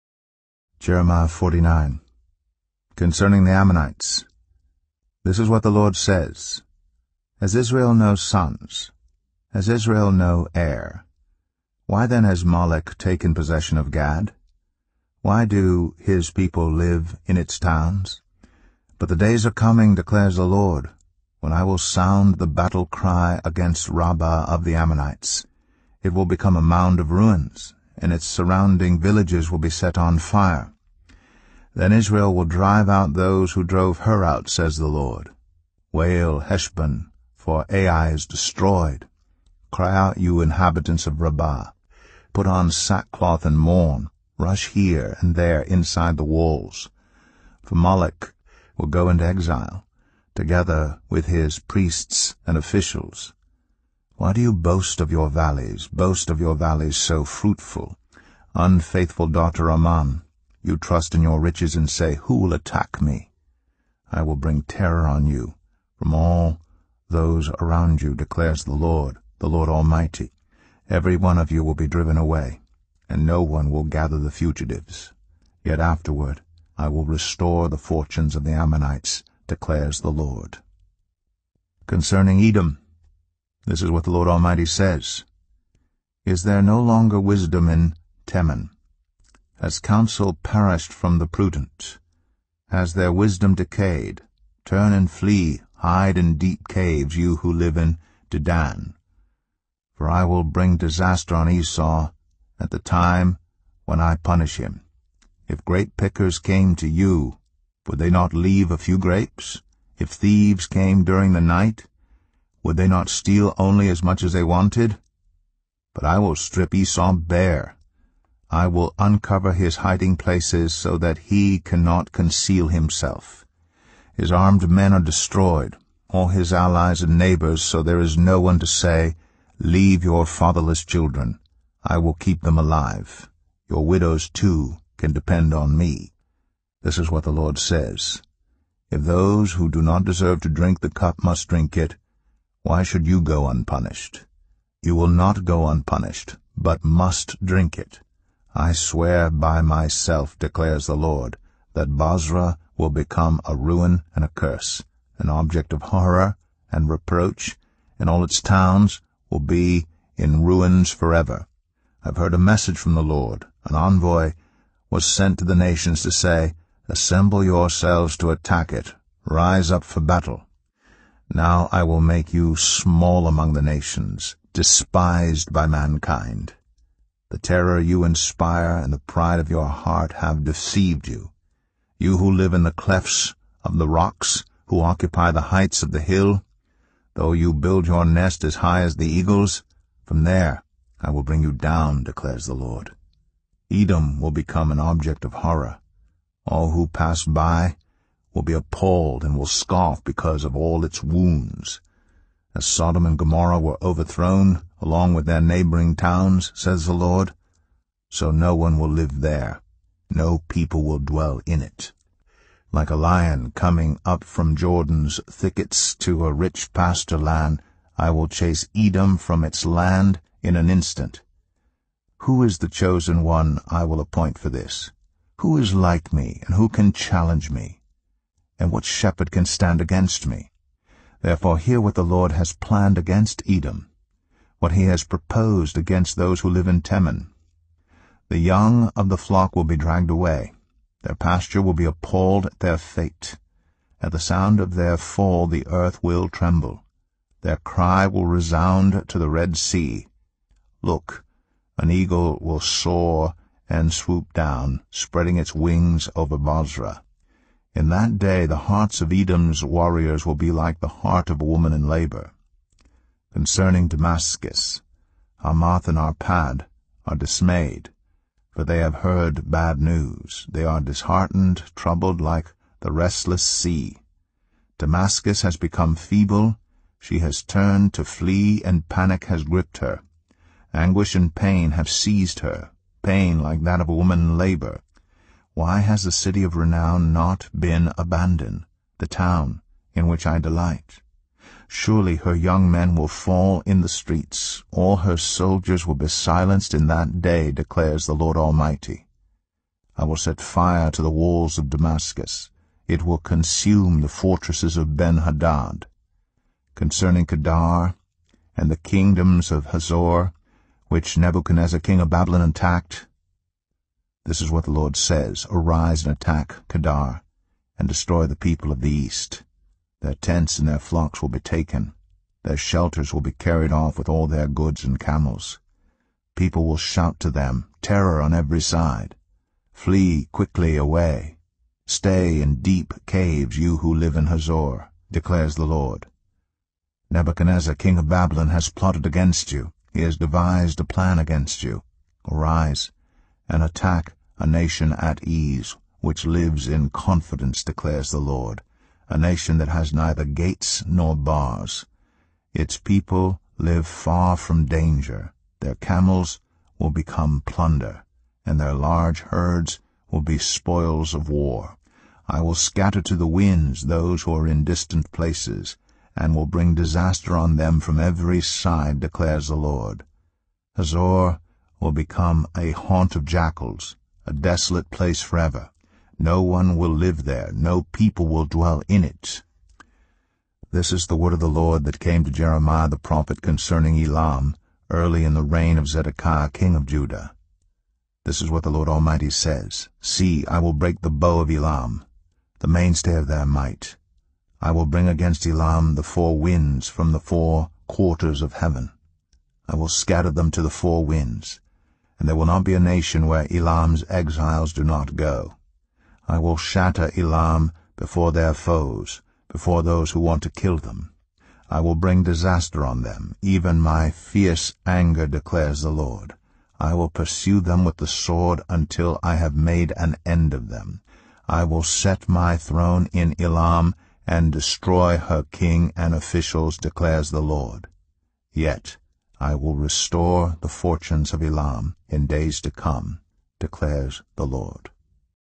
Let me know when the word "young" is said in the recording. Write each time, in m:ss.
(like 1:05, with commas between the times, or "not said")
3:58, 4:52.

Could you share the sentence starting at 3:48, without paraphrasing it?
and what shepherd can stand against me?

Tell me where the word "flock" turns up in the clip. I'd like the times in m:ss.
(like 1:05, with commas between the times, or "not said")
3:59, 5:20.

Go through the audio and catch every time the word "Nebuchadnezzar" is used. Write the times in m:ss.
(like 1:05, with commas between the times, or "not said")
5:11, 5:37.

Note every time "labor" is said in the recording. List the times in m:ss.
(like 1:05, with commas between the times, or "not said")
4:21, 4:44.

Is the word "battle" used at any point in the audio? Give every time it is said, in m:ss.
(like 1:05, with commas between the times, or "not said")
0:22, 2:49.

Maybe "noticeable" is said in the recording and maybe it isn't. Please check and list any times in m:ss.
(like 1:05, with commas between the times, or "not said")
not said.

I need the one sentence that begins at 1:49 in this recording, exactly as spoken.
If thieves came during the night, would they not steal only as much as they wanted?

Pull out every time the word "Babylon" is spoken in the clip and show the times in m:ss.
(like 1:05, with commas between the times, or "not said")
5:12, 5:38.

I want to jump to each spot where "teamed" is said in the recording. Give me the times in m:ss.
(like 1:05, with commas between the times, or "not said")
not said.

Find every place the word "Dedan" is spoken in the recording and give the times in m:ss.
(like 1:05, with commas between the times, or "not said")
1:38.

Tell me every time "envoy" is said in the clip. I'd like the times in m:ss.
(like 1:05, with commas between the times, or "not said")
2:43.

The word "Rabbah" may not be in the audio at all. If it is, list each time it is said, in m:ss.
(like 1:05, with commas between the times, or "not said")
0:23, 0:41.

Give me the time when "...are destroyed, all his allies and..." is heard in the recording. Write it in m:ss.
2:04.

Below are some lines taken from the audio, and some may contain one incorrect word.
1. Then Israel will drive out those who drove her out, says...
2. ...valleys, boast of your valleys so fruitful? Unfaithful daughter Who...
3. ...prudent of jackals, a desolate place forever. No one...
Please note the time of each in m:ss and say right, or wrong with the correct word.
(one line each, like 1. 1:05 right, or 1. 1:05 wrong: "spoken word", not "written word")
1. 0:31 right
2. 0:55 wrong: "Ammon", not "Who"
3. 6:12 wrong: "haunt", not "prudent".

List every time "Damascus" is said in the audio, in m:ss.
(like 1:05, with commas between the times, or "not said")
4:23, 4:34, 5:01.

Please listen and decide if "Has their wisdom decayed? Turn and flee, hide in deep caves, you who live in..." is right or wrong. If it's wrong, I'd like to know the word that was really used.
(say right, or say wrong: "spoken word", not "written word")
right.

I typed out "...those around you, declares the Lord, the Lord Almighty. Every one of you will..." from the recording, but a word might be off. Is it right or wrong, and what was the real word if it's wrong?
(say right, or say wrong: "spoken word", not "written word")
right.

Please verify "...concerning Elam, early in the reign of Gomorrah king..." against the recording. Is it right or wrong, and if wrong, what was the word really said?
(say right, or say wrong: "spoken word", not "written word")
wrong: "Zedekiah", not "Gomorrah".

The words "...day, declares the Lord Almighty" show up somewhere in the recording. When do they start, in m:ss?
4:57.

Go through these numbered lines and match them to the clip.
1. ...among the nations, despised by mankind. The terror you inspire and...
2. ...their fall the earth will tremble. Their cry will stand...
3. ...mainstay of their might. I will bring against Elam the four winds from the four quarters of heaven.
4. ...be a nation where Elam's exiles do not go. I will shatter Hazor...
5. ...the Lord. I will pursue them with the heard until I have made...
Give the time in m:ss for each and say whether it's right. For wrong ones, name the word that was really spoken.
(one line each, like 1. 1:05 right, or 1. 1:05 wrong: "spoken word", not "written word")
1. 2:53 right
2. 4:04 wrong: "resound", not "stand"
3. 6:32 right
4. 6:42 wrong: "Elam", not "Hazor"
5. 6:55 wrong: "sword", not "heard".